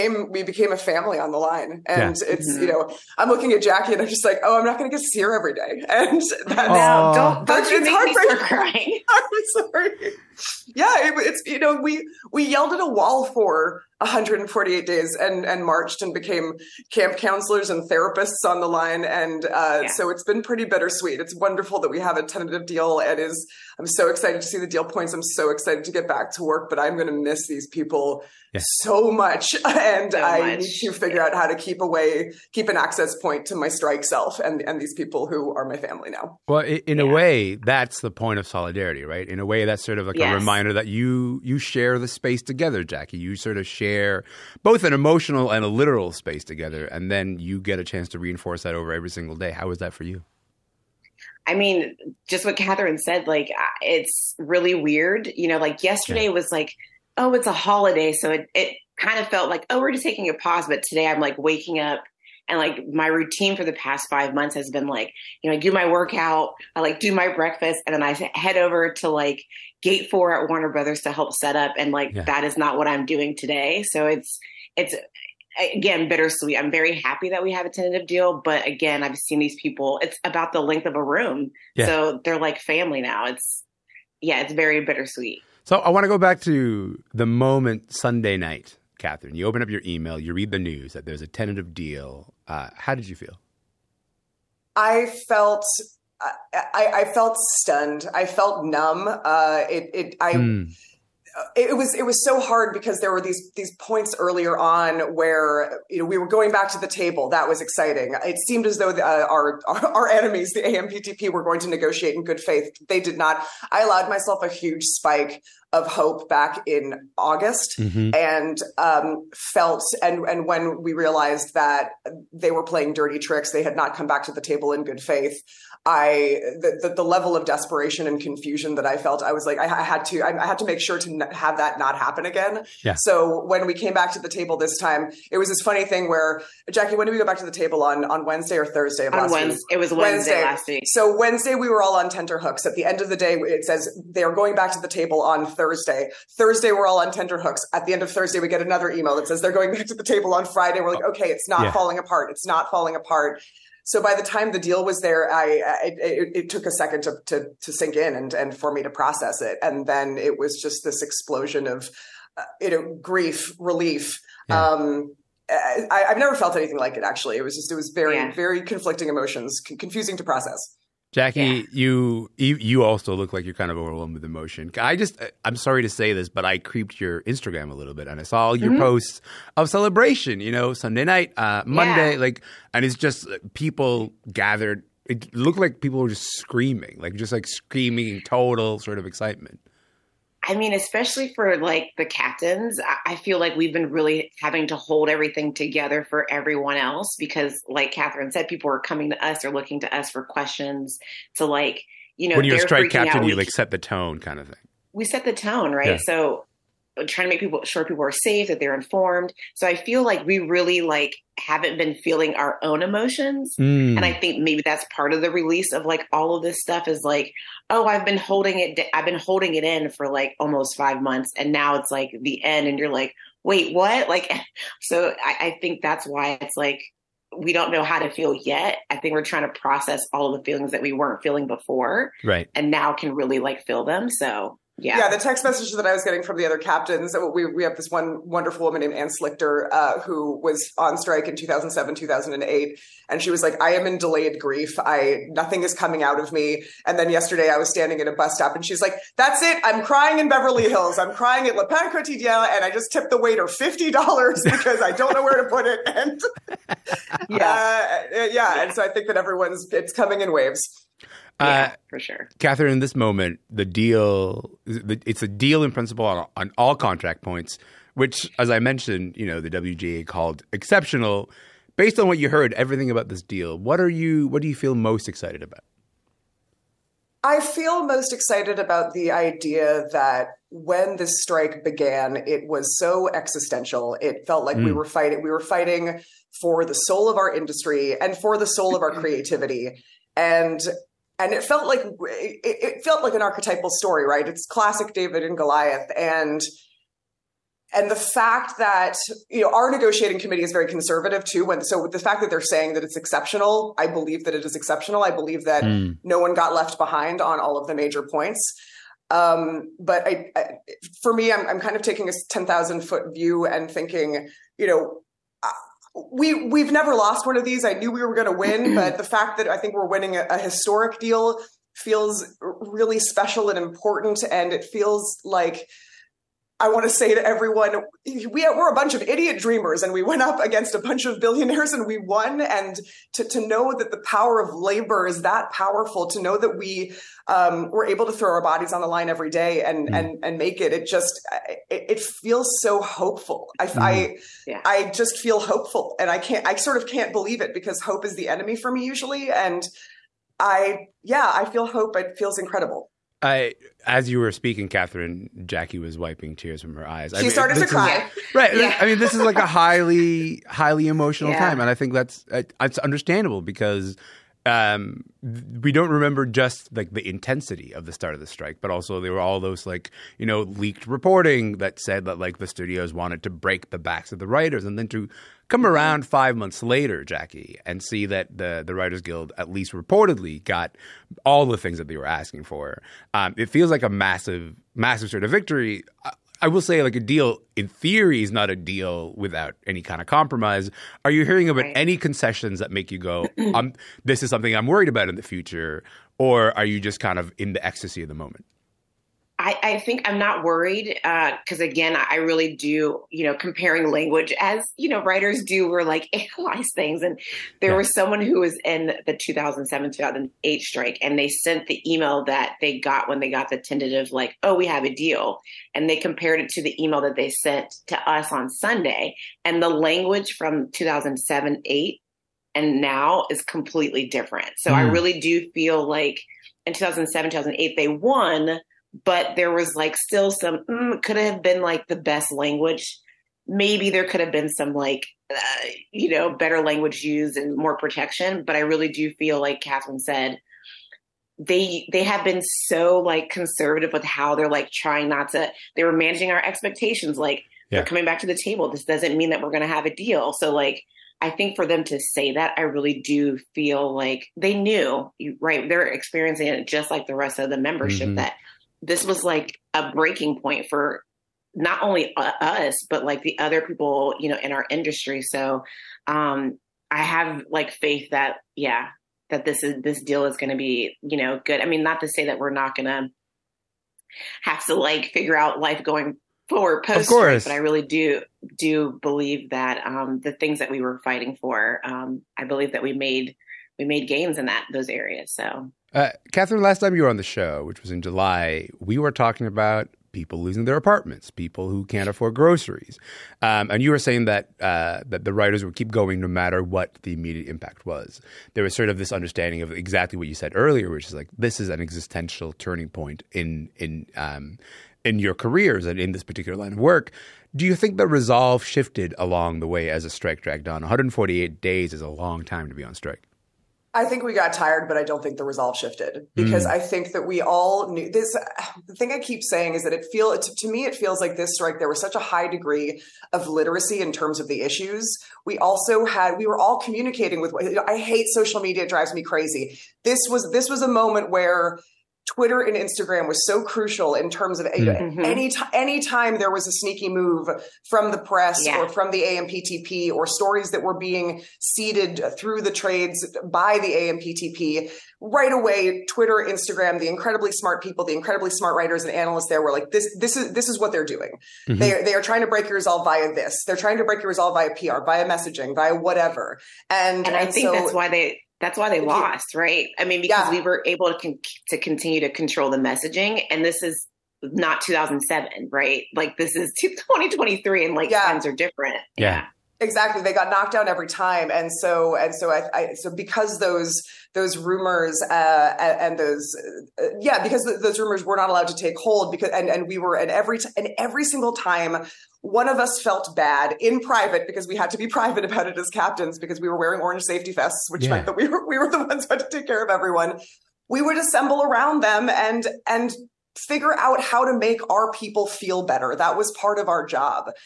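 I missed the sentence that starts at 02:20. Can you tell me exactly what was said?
So Wednesday we were all on tenterhooks.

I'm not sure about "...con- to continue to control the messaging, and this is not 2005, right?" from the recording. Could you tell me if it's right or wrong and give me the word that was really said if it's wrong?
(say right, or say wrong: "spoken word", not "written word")
wrong: "2007", not "2005".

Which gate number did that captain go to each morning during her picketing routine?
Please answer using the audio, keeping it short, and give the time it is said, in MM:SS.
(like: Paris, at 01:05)
Gate 4, at 01:09.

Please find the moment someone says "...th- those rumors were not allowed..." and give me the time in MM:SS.
09:37.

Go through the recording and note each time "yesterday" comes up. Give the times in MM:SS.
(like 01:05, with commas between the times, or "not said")
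00:55, 04:07.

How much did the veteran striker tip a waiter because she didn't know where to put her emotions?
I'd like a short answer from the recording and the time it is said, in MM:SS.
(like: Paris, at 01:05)
$50, at 04:13.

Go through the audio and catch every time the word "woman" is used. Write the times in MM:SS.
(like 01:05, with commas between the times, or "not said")
03:58.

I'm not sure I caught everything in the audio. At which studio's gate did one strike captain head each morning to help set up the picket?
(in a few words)
Warner Brothers.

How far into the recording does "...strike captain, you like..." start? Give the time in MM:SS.
03:22.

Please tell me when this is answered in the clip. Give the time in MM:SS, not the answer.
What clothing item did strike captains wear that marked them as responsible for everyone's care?
09:46.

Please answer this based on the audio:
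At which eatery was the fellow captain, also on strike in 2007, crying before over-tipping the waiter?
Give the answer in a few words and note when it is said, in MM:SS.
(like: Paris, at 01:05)
Le Pain Quotidien, at 04:11.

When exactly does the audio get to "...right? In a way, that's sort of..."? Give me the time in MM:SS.
00:39.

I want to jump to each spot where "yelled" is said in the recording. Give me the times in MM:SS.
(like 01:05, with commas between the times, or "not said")
00:12.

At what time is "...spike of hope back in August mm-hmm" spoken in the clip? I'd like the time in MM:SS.
01:54.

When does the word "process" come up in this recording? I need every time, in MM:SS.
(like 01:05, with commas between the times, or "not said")
02:39, 02:50, 03:49.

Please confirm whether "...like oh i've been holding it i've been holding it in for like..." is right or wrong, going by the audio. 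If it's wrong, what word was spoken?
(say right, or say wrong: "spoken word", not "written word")
right.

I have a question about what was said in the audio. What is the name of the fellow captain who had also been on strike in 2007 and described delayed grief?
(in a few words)
Anne Slichter.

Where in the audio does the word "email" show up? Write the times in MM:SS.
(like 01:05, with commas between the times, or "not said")
01:29, 02:28, 06:51, 06:56.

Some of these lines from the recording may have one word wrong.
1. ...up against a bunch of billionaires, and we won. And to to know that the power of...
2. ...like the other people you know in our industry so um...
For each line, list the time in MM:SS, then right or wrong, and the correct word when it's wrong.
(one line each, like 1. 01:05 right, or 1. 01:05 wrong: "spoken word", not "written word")
1. 05:30 right
2. 07:43 right.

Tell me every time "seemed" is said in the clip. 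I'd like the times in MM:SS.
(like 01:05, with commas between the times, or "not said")
01:48.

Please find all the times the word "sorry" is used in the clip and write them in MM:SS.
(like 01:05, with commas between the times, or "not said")
00:09, 02:55.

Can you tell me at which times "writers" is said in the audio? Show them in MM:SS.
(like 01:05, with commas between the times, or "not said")
06:14, 06:18, 06:45, 08:15, 09:08.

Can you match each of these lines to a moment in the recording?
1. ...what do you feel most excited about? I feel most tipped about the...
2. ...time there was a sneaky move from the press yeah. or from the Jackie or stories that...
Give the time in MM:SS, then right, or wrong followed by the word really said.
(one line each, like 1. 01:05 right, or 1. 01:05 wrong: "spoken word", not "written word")
1. 04:34 wrong: "excited", not "tipped"
2. 08:55 wrong: "AMPTP", not "Jackie".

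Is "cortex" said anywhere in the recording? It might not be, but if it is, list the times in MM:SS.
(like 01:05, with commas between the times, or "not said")
not said.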